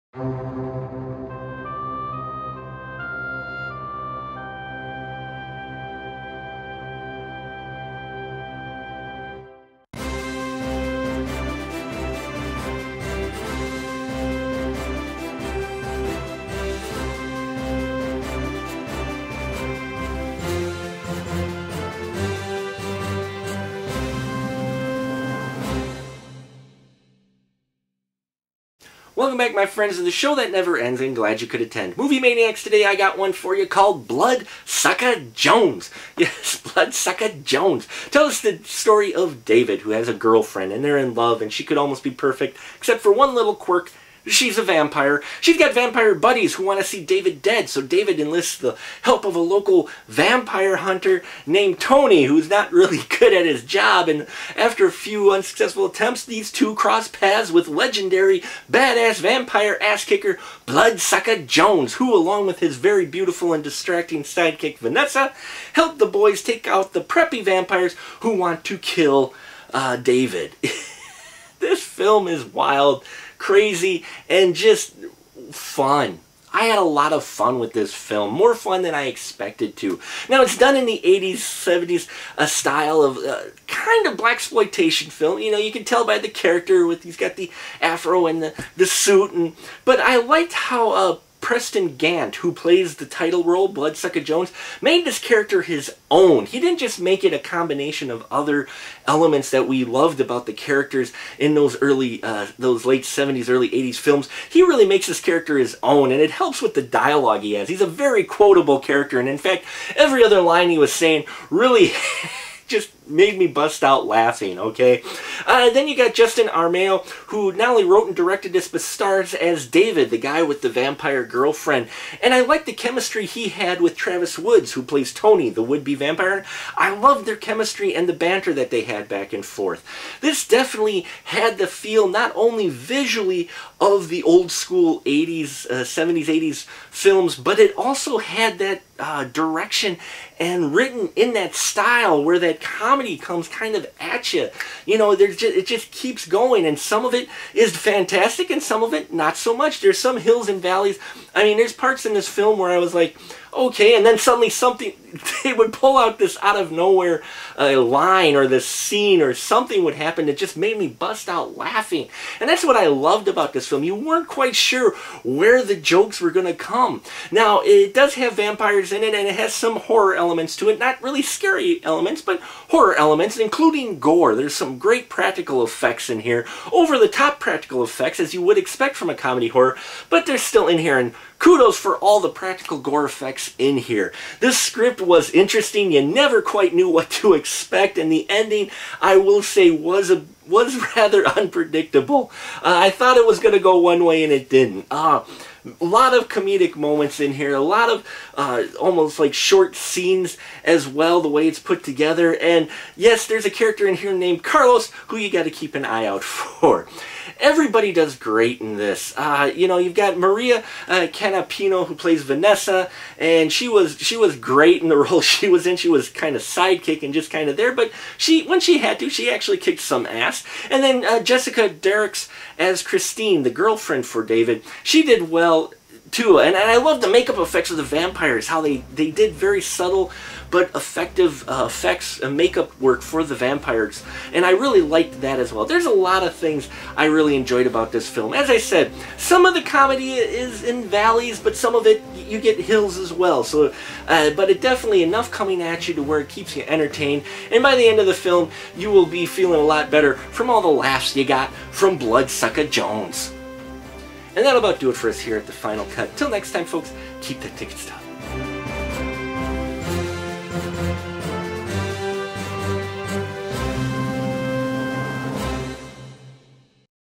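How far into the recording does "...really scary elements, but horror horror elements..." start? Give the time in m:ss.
2:51.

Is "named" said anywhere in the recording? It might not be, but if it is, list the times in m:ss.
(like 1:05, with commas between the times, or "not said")
0:51, 3:24.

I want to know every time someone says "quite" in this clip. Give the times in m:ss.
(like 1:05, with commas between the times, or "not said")
2:44, 3:06.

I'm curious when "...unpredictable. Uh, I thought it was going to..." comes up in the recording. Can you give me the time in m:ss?
3:11.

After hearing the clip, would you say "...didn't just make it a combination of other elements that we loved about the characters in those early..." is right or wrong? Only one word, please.
right.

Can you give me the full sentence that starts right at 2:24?
You know, there's just, it just keeps going, and some of it is fantastic, and some of it not so much.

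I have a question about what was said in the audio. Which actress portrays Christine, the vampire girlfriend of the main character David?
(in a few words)
Jessica Derricks.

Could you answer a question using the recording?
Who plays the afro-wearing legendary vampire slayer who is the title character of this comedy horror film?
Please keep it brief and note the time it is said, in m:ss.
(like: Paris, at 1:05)
Preston Gant, at 1:31.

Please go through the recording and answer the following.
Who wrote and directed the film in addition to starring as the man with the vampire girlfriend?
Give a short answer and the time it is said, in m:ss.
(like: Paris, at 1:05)
Justin Armeo, at 1:56.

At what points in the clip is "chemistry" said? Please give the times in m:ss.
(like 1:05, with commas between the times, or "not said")
2:02, 2:07.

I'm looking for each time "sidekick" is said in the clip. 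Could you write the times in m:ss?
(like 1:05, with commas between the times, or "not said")
1:04, 3:36.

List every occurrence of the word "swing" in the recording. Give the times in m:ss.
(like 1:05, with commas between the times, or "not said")
not said.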